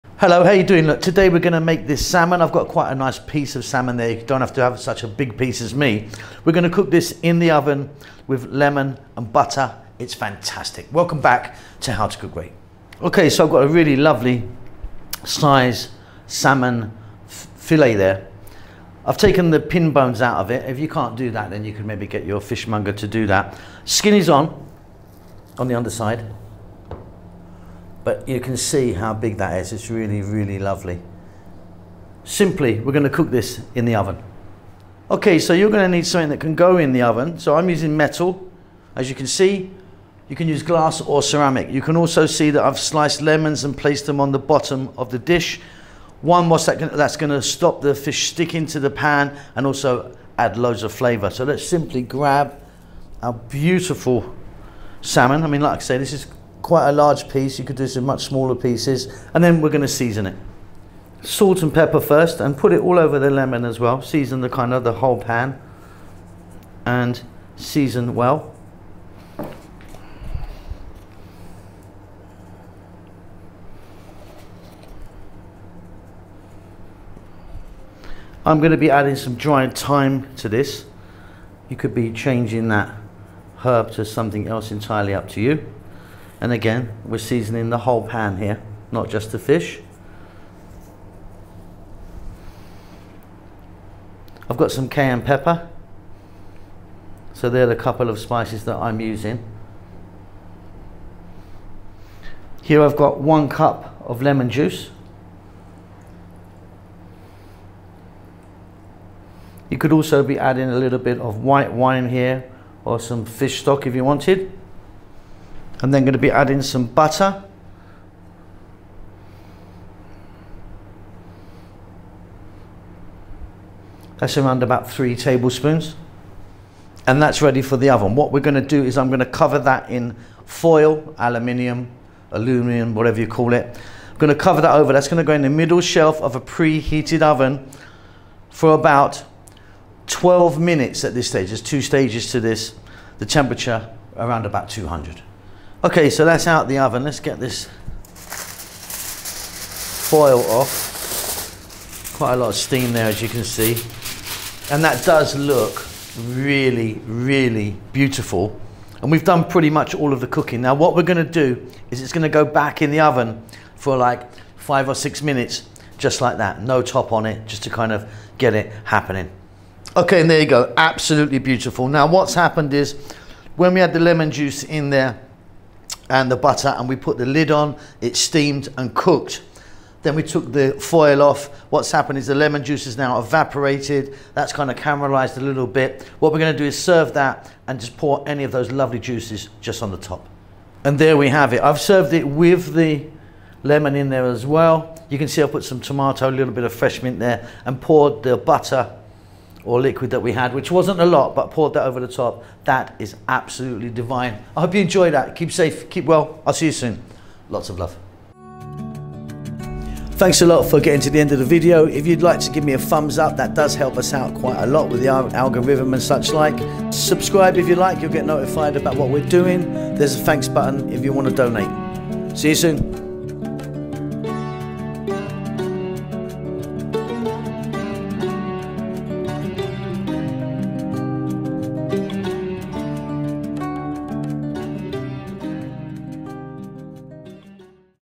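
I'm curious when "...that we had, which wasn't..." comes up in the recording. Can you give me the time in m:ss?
3:20.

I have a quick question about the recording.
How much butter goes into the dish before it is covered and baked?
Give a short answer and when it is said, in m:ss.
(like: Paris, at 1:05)
3 tablespoons, at 2:04.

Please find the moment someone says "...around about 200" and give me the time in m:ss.
2:24.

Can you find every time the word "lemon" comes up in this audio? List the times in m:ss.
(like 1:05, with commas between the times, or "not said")
0:08, 0:43, 1:03, 1:44, 2:53, 3:02, 3:13.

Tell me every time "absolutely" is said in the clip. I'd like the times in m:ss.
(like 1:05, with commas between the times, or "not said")
2:50, 3:23.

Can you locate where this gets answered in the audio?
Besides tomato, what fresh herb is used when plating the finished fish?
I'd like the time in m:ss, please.
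3:16.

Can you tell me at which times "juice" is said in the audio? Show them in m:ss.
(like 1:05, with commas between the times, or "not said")
1:44, 2:54, 3:02, 3:08.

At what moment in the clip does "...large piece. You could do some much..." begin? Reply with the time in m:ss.
0:56.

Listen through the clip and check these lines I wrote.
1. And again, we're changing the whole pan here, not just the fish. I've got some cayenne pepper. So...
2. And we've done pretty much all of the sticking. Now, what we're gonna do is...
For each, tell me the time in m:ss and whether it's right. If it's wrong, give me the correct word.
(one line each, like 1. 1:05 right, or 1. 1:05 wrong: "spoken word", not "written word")
1. 1:26 wrong: "seasoning", not "changing"
2. 2:39 wrong: "cooking", not "sticking".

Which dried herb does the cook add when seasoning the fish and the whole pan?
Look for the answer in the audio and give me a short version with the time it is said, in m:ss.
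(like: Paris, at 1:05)
Thyme, at 1:19.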